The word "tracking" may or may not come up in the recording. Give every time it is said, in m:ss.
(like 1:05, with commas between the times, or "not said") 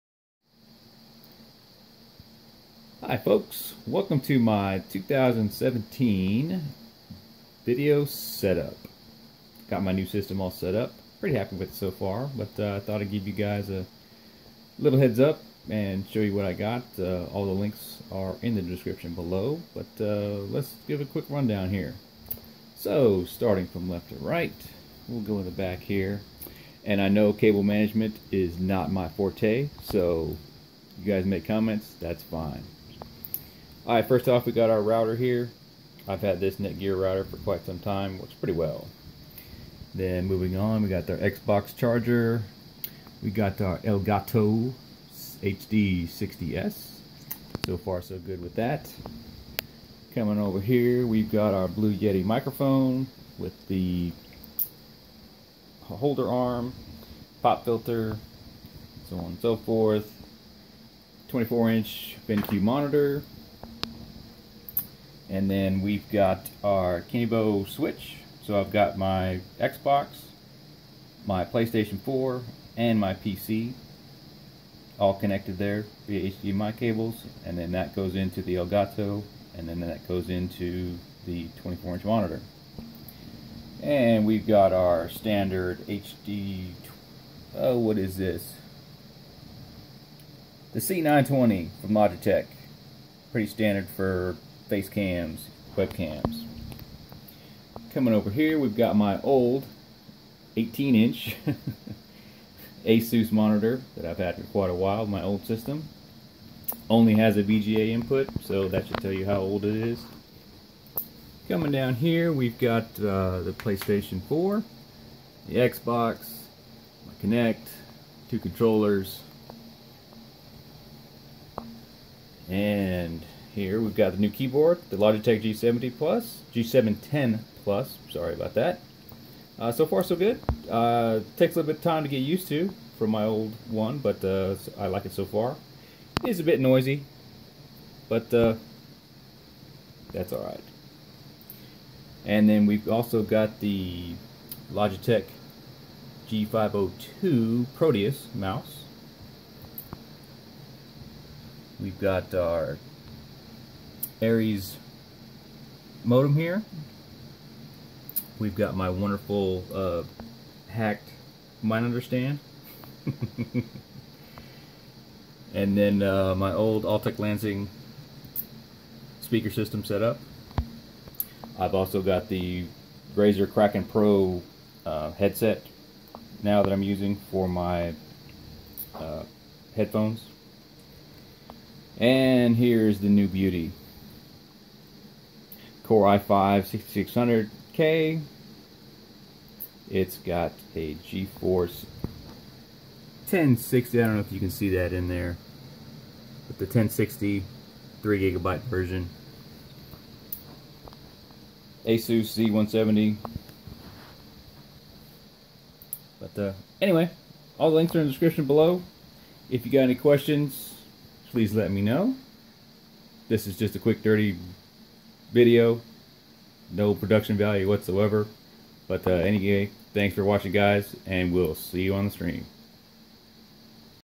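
not said.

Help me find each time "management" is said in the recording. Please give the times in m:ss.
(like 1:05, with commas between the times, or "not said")
0:27.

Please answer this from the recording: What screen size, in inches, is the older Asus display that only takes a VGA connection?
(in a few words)
18.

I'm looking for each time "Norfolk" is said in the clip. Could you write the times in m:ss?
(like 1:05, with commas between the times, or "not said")
not said.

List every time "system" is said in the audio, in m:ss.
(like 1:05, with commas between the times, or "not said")
0:10, 1:45, 2:49.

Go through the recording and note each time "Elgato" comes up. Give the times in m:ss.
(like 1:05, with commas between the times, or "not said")
0:43, 1:18.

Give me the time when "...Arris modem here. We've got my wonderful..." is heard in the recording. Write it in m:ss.
2:34.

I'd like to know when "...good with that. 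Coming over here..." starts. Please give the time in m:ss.
0:48.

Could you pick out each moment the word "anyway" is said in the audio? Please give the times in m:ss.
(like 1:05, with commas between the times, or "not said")
3:26, 3:39.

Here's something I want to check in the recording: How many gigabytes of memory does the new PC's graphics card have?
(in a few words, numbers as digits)
3.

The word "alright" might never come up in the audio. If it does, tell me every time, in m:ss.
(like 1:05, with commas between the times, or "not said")
0:33, 2:20.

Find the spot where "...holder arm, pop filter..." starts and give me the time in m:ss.
0:55.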